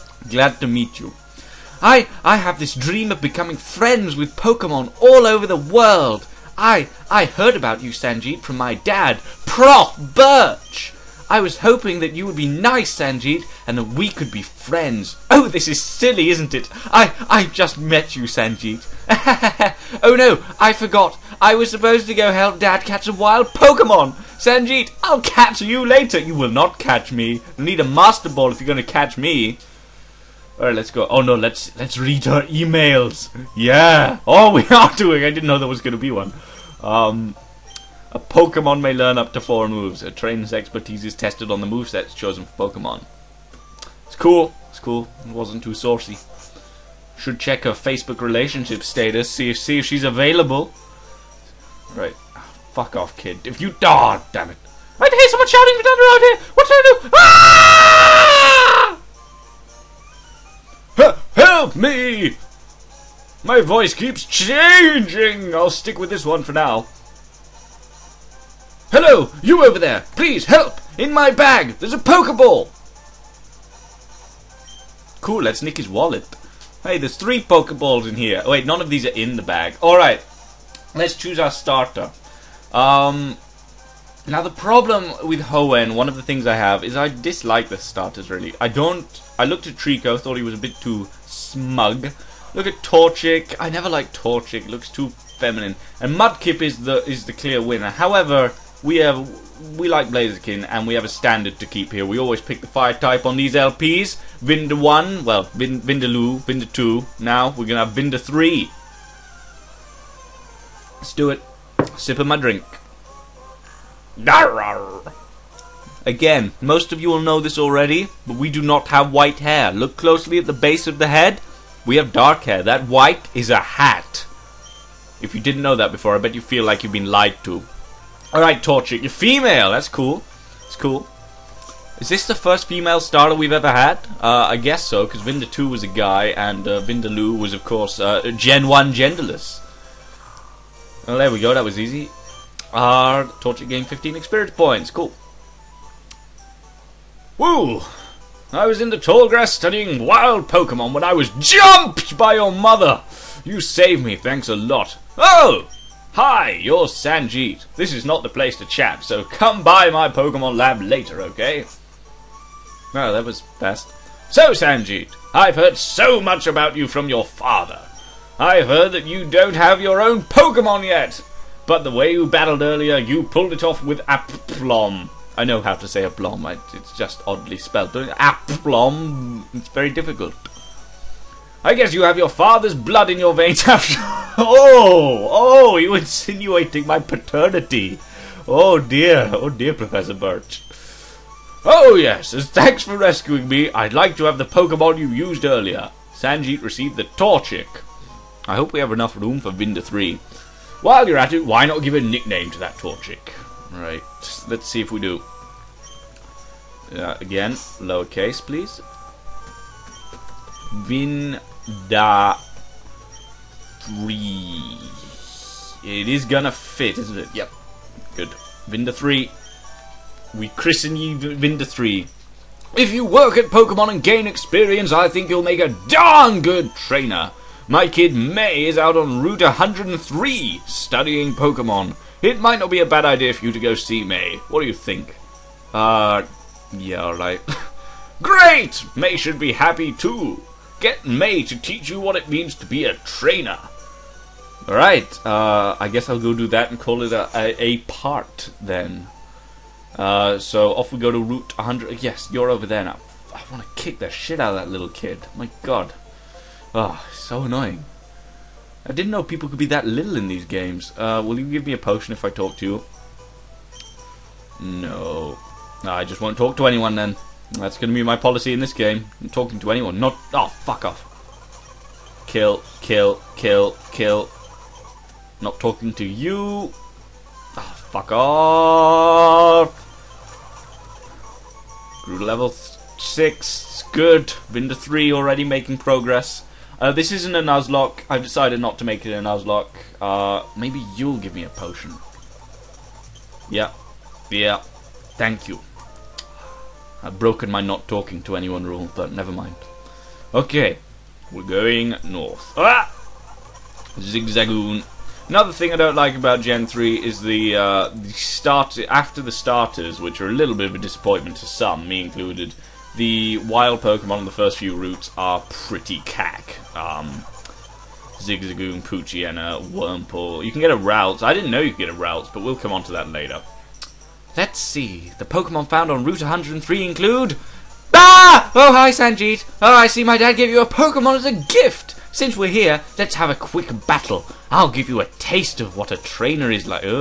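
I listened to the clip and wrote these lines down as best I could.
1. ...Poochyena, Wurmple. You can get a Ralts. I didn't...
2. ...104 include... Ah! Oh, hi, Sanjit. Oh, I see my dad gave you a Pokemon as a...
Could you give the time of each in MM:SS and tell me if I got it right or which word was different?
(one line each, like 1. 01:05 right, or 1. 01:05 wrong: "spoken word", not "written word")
1. 05:18 right
2. 05:26 wrong: "103", not "104".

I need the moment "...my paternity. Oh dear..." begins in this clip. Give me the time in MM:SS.
03:06.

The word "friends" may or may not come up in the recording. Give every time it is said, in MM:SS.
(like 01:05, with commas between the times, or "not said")
00:03, 00:14.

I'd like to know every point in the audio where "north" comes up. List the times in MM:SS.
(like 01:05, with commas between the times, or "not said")
05:02.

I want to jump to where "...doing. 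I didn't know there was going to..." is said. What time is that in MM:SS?
00:34.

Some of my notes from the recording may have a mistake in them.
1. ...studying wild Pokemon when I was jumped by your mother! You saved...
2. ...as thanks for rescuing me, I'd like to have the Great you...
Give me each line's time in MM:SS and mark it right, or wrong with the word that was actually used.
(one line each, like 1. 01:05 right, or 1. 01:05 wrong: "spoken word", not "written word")
1. 02:29 right
2. 03:12 wrong: "Pokemon", not "Great".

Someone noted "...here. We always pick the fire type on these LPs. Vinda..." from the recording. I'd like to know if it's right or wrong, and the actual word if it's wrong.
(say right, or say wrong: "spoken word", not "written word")
right.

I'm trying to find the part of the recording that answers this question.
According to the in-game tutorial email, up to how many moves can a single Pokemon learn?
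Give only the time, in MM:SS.
00:39.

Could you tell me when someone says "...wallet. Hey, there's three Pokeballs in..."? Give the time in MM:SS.
01:15.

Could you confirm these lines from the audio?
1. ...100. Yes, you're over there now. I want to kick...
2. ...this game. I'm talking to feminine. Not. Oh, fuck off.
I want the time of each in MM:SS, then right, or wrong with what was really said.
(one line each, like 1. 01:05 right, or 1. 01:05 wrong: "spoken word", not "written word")
1. 04:11 right
2. 04:28 wrong: "anyone", not "feminine".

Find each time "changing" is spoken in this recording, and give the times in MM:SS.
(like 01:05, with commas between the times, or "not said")
01:04.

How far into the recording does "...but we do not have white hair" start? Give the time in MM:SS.
01:58.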